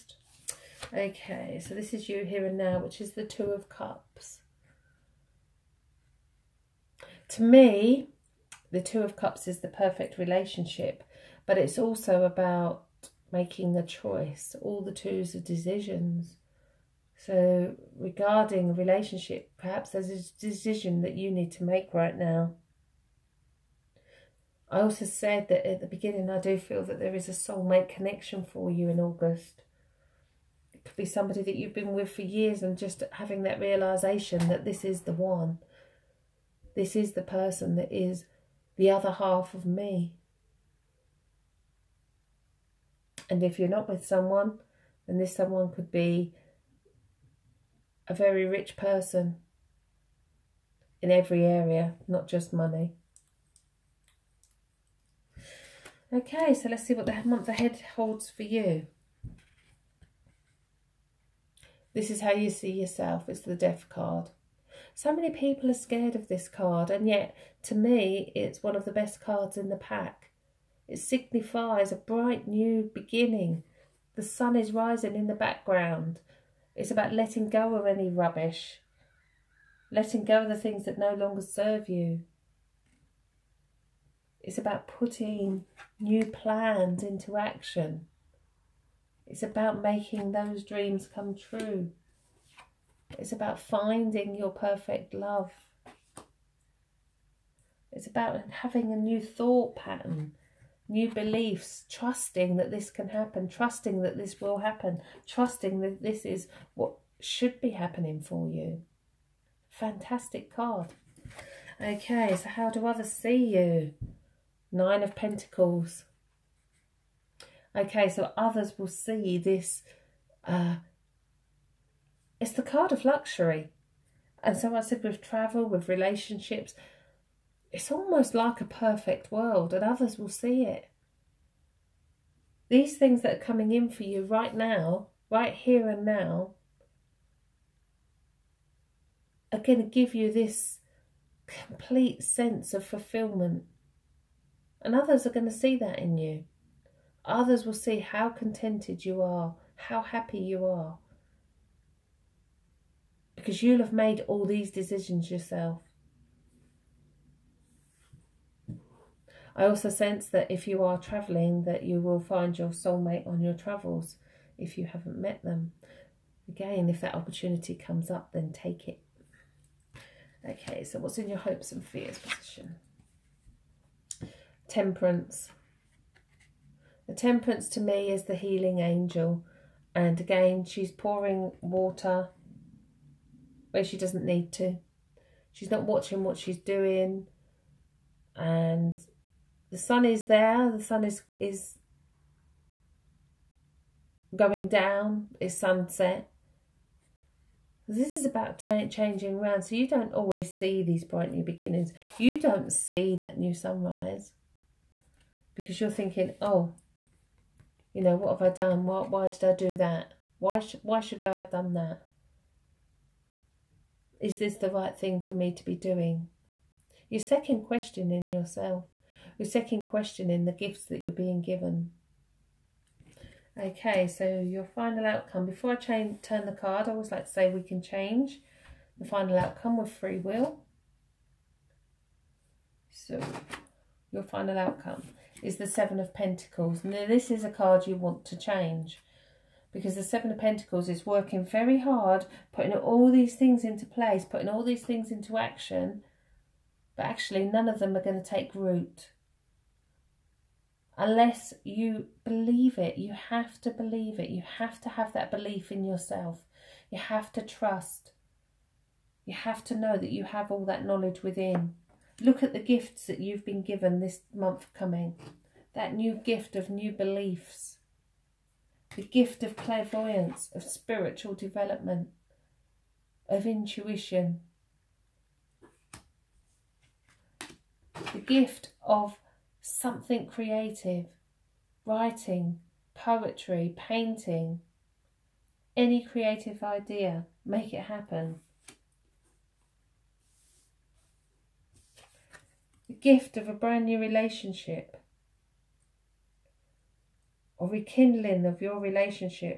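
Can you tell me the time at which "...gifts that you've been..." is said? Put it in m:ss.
4:22.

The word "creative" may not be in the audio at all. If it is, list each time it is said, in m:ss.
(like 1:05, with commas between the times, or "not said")
4:40, 4:46.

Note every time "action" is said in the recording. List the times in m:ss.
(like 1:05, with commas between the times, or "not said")
1:27, 4:05.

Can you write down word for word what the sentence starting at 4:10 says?
Unless you believe it, you have to believe it.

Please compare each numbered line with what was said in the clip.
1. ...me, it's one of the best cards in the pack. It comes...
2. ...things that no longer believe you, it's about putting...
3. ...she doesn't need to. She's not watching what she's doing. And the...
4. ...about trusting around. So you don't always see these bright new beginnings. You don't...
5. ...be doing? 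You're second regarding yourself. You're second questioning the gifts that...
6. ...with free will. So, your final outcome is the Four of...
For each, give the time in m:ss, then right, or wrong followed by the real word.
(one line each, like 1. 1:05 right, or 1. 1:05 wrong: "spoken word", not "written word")
1. 1:07 wrong: "signifies", not "comes"
2. 1:20 wrong: "serve", not "believe"
3. 3:03 right
4. 3:18 wrong: "changing", not "trusting"
5. 3:35 wrong: "questioning", not "regarding"
6. 3:49 wrong: "Seven", not "Four".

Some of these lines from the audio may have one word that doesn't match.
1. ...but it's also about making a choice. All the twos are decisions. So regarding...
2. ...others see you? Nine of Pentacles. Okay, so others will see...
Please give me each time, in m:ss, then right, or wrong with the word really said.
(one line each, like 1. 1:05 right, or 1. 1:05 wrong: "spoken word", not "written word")
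1. 0:11 right
2. 1:52 right.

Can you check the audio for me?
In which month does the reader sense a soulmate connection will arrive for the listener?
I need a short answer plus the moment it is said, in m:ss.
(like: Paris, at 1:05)
August, at 0:28.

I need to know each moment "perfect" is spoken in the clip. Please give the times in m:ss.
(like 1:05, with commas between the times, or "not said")
0:09, 1:34, 2:08.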